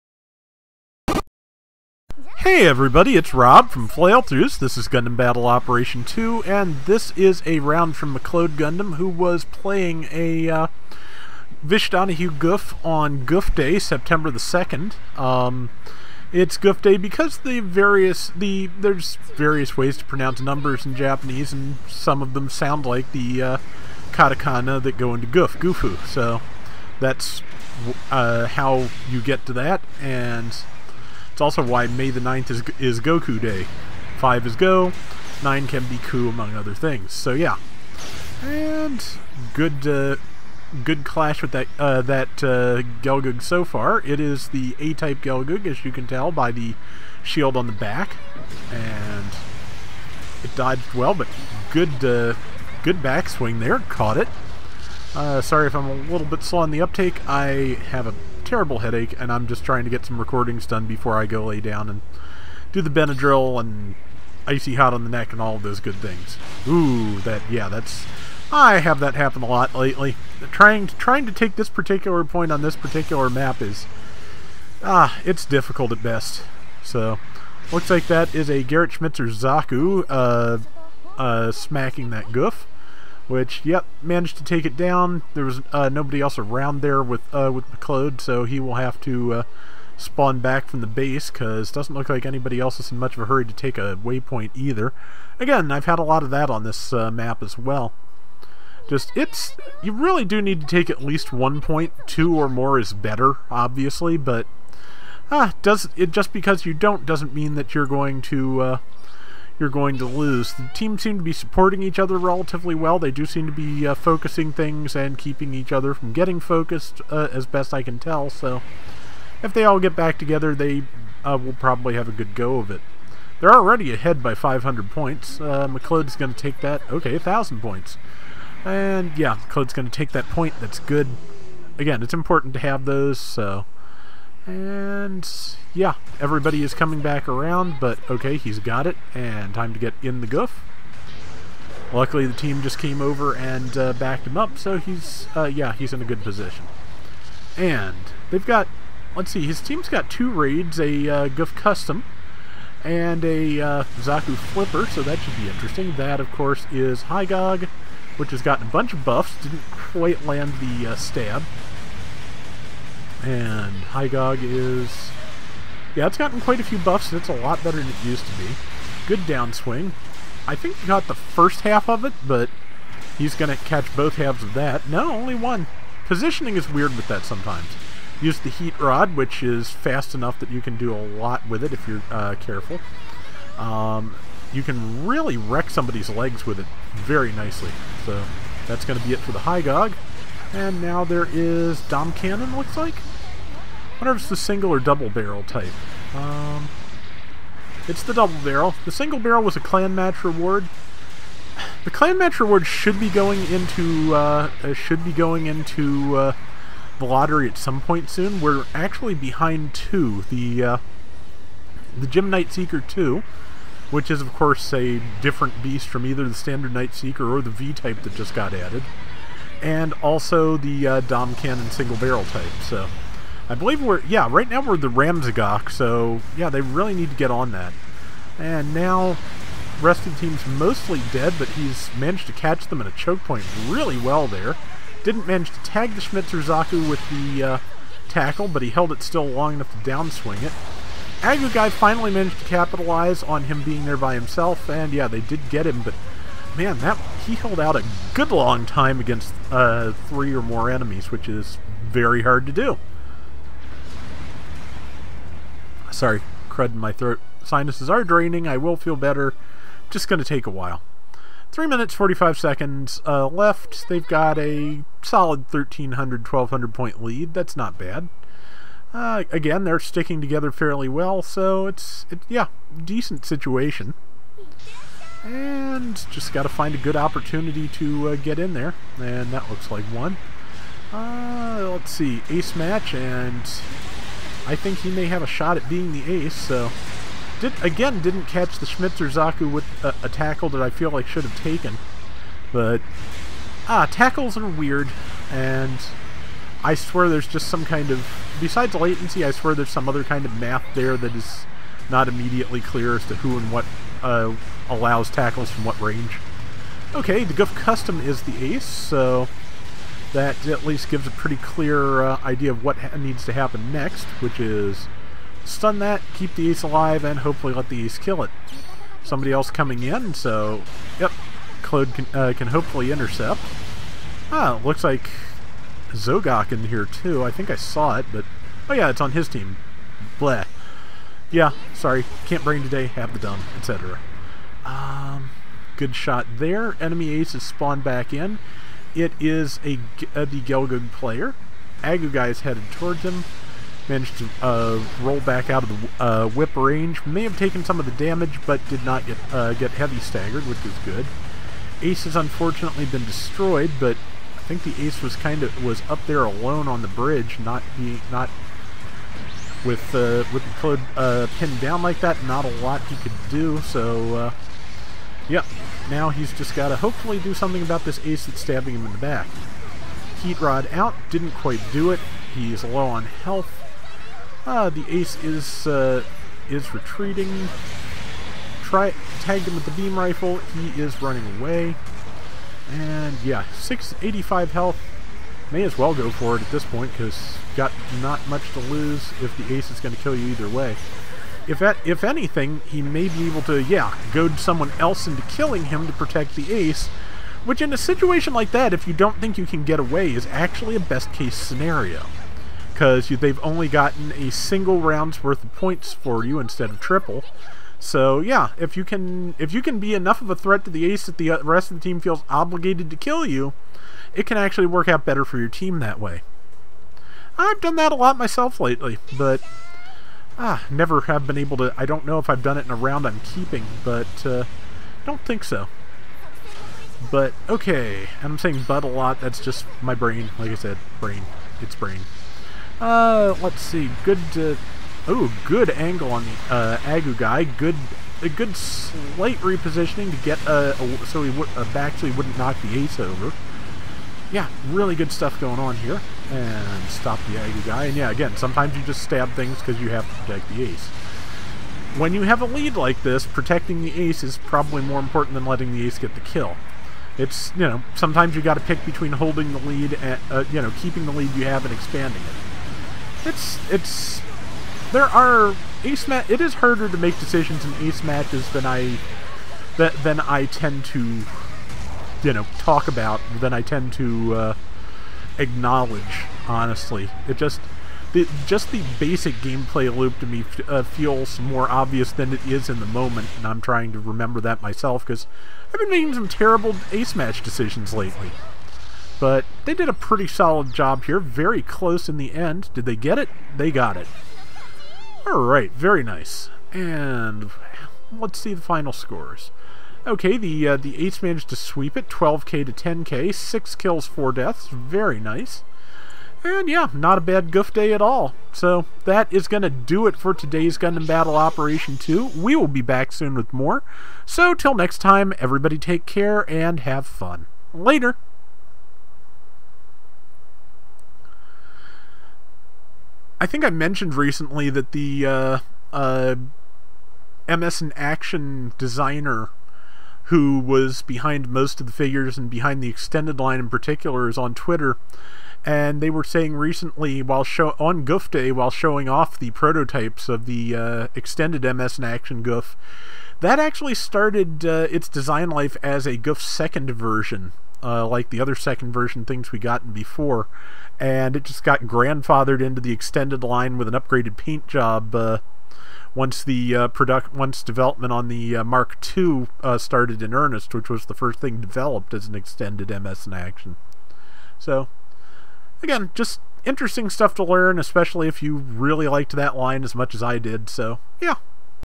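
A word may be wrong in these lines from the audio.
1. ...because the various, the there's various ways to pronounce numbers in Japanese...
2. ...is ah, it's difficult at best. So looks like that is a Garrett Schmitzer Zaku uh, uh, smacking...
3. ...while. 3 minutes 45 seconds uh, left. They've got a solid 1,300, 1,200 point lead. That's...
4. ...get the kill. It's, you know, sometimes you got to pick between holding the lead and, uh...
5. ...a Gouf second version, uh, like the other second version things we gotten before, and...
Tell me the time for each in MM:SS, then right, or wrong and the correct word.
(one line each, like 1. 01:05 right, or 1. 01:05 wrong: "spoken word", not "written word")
1. 00:16 right
2. 01:13 right
3. 04:20 right
4. 07:35 right
5. 09:06 right.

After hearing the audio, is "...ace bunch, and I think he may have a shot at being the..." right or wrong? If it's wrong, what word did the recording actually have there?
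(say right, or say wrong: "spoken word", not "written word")
wrong: "match", not "bunch".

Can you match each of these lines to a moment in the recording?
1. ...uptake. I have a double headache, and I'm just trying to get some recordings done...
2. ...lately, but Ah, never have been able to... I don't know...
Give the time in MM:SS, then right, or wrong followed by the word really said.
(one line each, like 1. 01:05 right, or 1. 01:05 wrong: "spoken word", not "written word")
1. 00:56 wrong: "terrible", not "double"
2. 06:58 right.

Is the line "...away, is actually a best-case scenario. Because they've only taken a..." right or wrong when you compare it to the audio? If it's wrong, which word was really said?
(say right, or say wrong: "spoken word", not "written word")
wrong: "gotten", not "taken".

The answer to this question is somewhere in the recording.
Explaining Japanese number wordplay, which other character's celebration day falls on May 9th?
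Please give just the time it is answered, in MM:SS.
00:32.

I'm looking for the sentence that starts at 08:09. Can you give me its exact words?
But they did a pretty solid job here, very close in the end.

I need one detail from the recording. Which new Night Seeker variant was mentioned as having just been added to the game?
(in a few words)
V type.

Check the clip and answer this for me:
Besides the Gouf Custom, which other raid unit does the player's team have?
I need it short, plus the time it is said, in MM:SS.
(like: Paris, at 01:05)
Zaku Flipper, at 02:33.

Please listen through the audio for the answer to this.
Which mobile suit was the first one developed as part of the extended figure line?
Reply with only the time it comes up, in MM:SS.
09:18.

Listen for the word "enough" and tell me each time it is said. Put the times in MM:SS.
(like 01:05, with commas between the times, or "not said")
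03:00, 03:59, 06:49.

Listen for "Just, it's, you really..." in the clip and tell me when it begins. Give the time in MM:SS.
01:38.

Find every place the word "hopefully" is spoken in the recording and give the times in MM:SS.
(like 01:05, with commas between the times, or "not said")
05:17, 05:22, 06:06.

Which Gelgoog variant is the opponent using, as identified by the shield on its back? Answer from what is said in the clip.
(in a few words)
A-type.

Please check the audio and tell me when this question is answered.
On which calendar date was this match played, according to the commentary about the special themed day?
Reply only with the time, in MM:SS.
00:13.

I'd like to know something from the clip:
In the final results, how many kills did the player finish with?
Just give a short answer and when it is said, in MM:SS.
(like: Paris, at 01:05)
6, at 08:23.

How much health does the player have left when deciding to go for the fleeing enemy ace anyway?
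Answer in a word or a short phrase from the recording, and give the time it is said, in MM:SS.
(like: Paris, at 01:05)
685, at 06:23.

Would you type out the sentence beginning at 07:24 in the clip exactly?
Yeah, really good stuff going on here and stop the guy.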